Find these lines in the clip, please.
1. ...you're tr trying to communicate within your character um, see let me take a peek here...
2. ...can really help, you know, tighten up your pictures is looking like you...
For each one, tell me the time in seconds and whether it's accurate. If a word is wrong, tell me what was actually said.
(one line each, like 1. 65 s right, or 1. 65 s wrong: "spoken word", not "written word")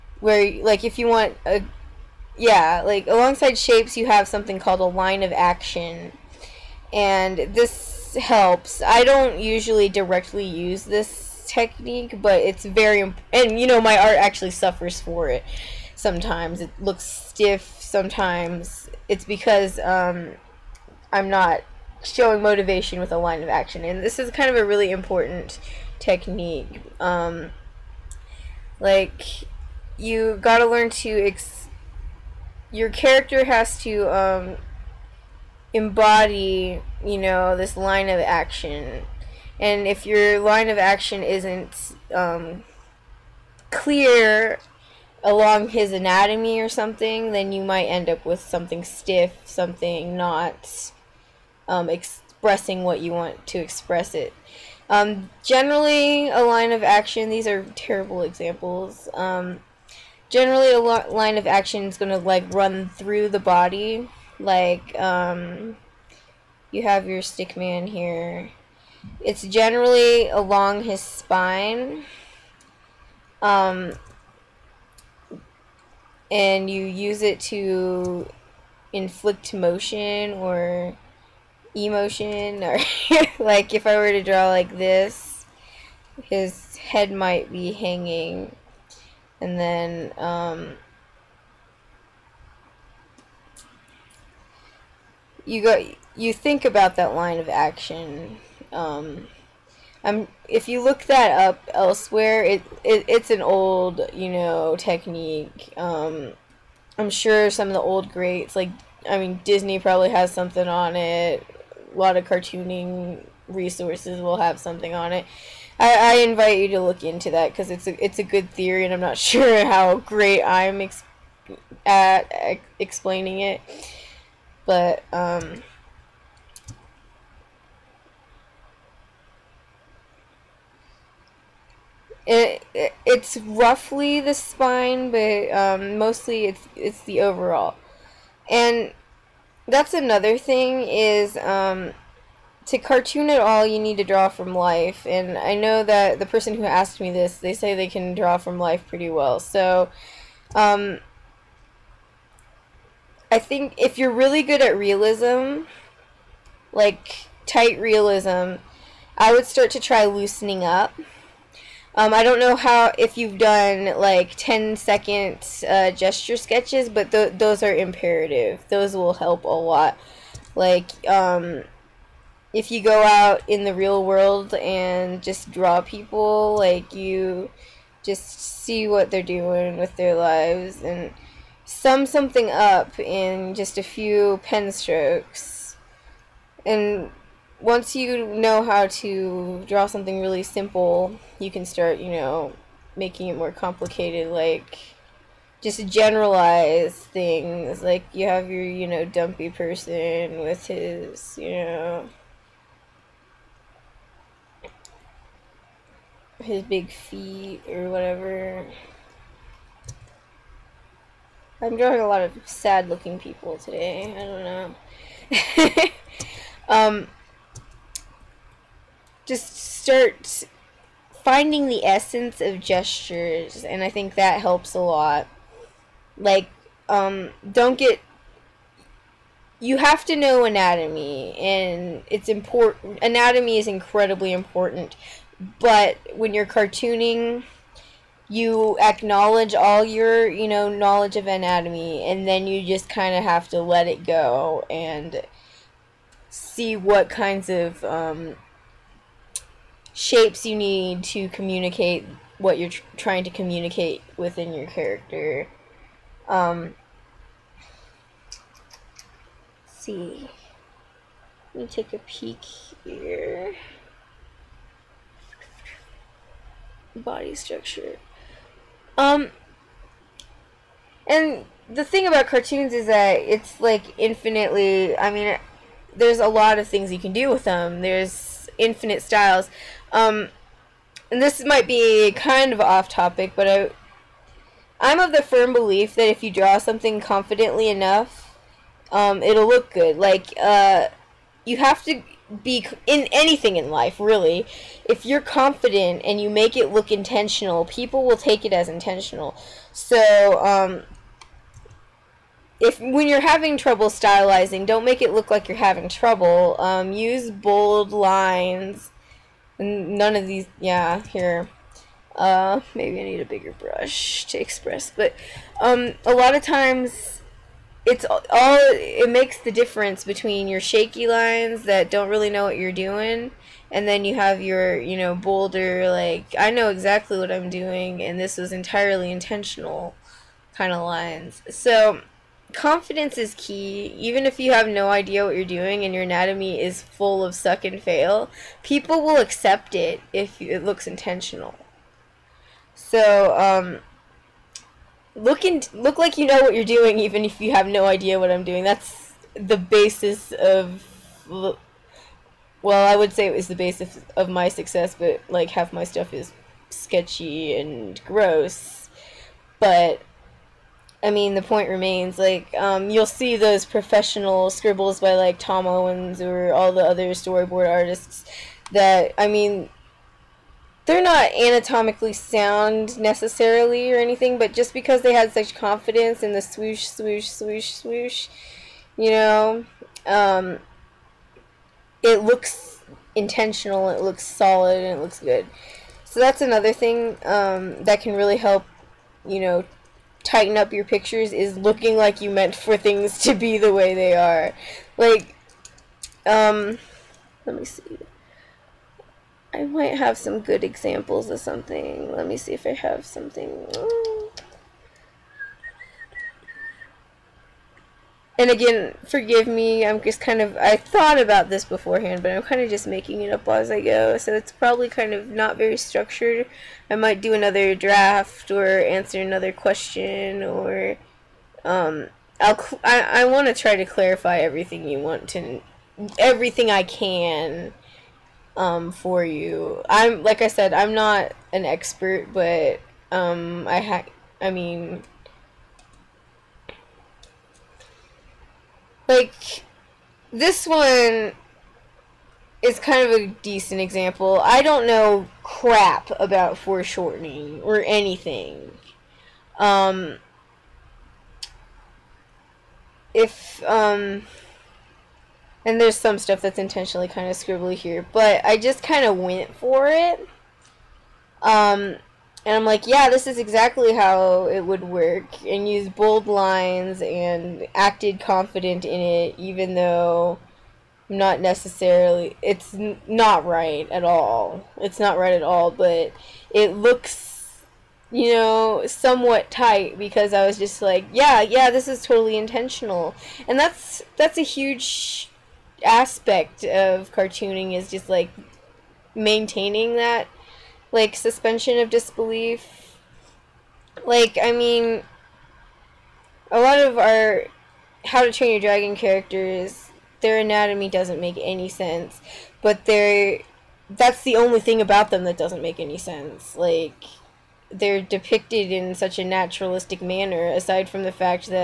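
1. 252 s right
2. 388 s right.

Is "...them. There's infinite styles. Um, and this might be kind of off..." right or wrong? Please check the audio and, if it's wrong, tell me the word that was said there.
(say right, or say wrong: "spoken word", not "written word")
right.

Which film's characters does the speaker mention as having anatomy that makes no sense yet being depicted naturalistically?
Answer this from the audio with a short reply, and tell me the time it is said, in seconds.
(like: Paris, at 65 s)
How to Train Your Dragon, at 498 s.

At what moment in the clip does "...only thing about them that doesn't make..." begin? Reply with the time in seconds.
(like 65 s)
504 s.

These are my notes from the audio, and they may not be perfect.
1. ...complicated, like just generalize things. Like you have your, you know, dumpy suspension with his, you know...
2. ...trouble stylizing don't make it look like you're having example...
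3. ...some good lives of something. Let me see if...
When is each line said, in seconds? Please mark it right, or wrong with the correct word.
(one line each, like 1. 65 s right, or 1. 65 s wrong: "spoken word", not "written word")
1. 193 s wrong: "person", not "suspension"
2. 303 s wrong: "trouble", not "example"
3. 400 s wrong: "examples", not "lives".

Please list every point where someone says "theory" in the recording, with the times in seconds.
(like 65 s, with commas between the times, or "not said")
118 s.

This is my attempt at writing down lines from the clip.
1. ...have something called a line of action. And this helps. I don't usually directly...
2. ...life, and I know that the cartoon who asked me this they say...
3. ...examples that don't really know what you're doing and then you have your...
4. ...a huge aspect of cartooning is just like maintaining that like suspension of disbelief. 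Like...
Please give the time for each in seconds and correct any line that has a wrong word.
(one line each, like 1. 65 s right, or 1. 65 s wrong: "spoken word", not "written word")
1. 4 s right
2. 144 s wrong: "person", not "cartoon"
3. 321 s wrong: "lines", not "examples"
4. 484 s right.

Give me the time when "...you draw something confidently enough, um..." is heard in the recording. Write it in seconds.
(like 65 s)
286 s.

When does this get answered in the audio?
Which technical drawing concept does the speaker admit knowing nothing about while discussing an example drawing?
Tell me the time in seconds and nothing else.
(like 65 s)
446 s.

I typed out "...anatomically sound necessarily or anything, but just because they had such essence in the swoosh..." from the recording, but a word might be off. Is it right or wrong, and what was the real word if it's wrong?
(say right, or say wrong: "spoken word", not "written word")
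wrong: "confidence", not "essence".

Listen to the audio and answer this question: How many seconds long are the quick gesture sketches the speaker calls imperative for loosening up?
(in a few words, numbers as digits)
10.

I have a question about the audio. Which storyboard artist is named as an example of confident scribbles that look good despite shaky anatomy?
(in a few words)
Tom Owens.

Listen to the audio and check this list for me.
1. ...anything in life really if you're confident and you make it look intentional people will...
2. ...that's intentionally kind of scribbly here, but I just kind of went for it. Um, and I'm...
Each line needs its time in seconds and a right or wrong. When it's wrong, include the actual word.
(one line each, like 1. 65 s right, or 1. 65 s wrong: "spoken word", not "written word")
1. 293 s right
2. 456 s right.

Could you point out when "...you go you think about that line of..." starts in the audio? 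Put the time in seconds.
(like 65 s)
95 s.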